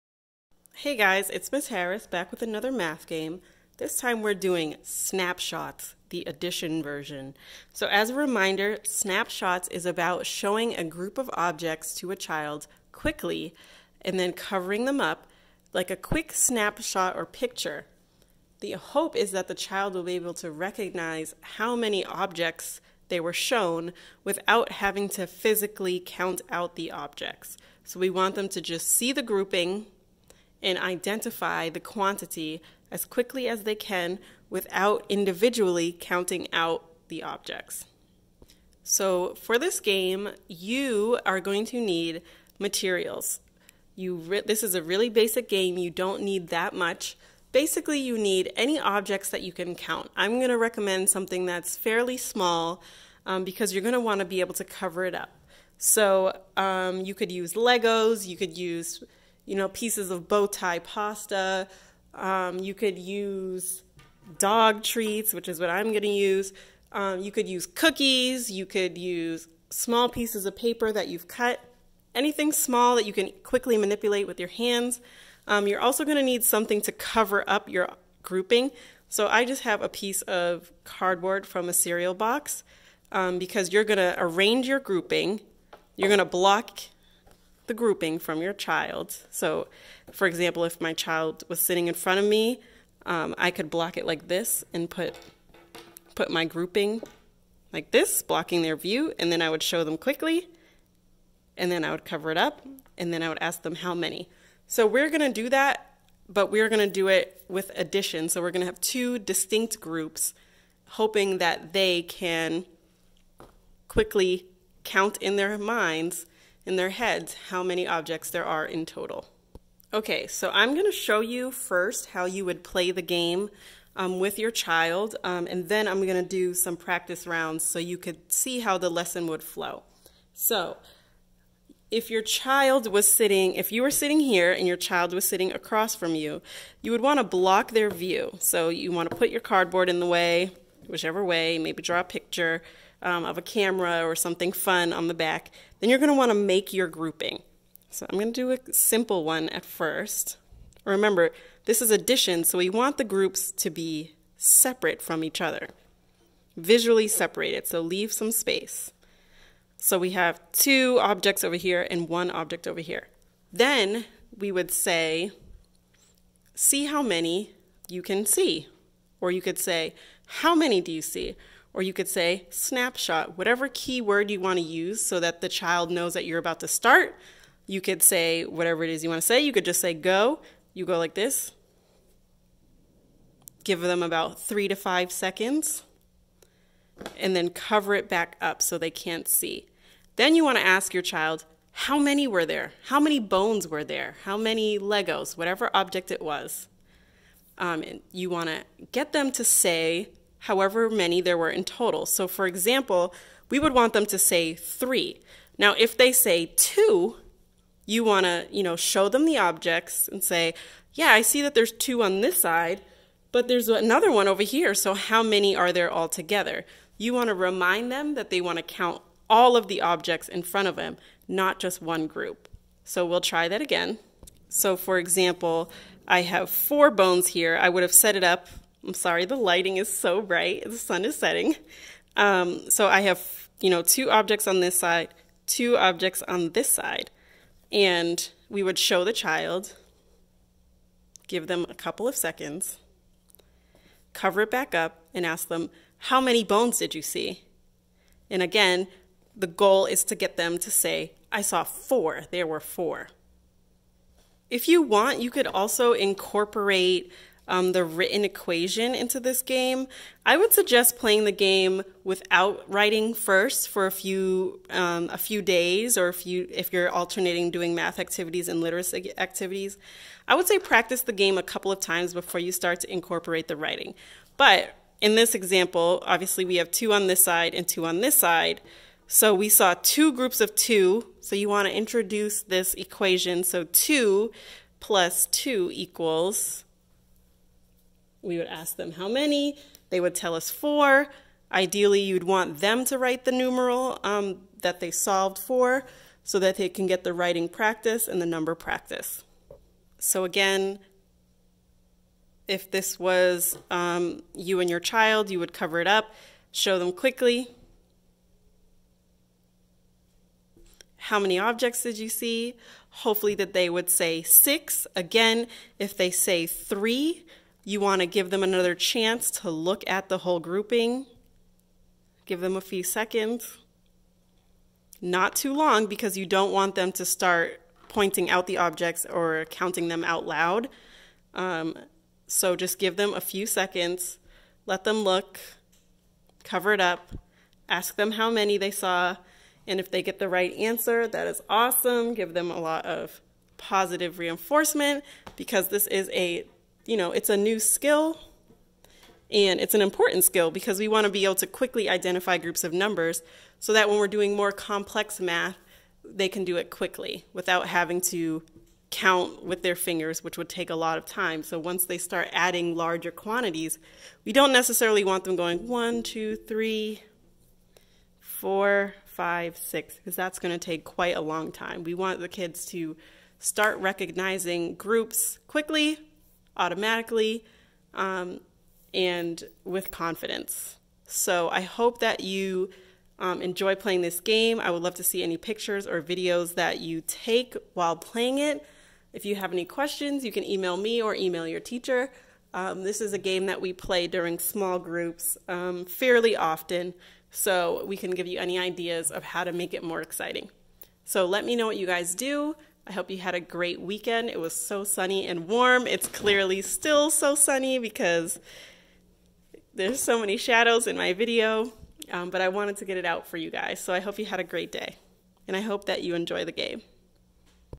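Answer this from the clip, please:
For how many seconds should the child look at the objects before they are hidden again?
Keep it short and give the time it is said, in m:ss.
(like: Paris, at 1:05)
3 to 5 seconds, at 3:04.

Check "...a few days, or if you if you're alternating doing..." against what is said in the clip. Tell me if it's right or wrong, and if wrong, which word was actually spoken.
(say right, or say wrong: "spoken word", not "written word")
right.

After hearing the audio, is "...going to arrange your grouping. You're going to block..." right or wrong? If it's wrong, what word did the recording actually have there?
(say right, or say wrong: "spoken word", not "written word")
right.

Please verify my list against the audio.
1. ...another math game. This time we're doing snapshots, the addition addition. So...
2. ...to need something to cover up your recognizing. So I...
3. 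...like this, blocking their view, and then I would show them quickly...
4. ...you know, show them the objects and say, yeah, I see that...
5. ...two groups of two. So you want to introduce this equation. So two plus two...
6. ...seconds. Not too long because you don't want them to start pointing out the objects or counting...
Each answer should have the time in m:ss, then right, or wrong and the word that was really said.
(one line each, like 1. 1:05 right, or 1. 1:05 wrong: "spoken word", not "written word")
1. 0:02 wrong: "version", not "addition"
2. 1:16 wrong: "grouping", not "recognizing"
3. 1:37 right
4. 3:28 right
5. 4:39 right
6. 5:22 right.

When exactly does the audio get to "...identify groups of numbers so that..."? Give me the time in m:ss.
5:51.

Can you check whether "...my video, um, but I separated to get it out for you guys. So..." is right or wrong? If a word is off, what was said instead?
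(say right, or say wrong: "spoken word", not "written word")
wrong: "wanted", not "separated".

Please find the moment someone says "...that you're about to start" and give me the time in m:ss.
2:56.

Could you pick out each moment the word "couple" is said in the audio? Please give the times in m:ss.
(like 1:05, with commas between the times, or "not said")
4:01, 4:31.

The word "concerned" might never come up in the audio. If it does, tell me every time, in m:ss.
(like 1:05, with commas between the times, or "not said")
not said.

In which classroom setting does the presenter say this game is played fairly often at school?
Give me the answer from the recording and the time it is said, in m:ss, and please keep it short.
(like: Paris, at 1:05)
small groups, at 6:34.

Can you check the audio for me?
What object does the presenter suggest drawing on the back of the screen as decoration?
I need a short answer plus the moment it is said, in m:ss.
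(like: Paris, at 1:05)
a camera, at 2:23.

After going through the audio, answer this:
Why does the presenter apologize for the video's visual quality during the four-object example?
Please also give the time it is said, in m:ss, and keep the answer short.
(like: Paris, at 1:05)
the sun is setting, at 3:50.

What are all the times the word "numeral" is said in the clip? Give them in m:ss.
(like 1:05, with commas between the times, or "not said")
4:53.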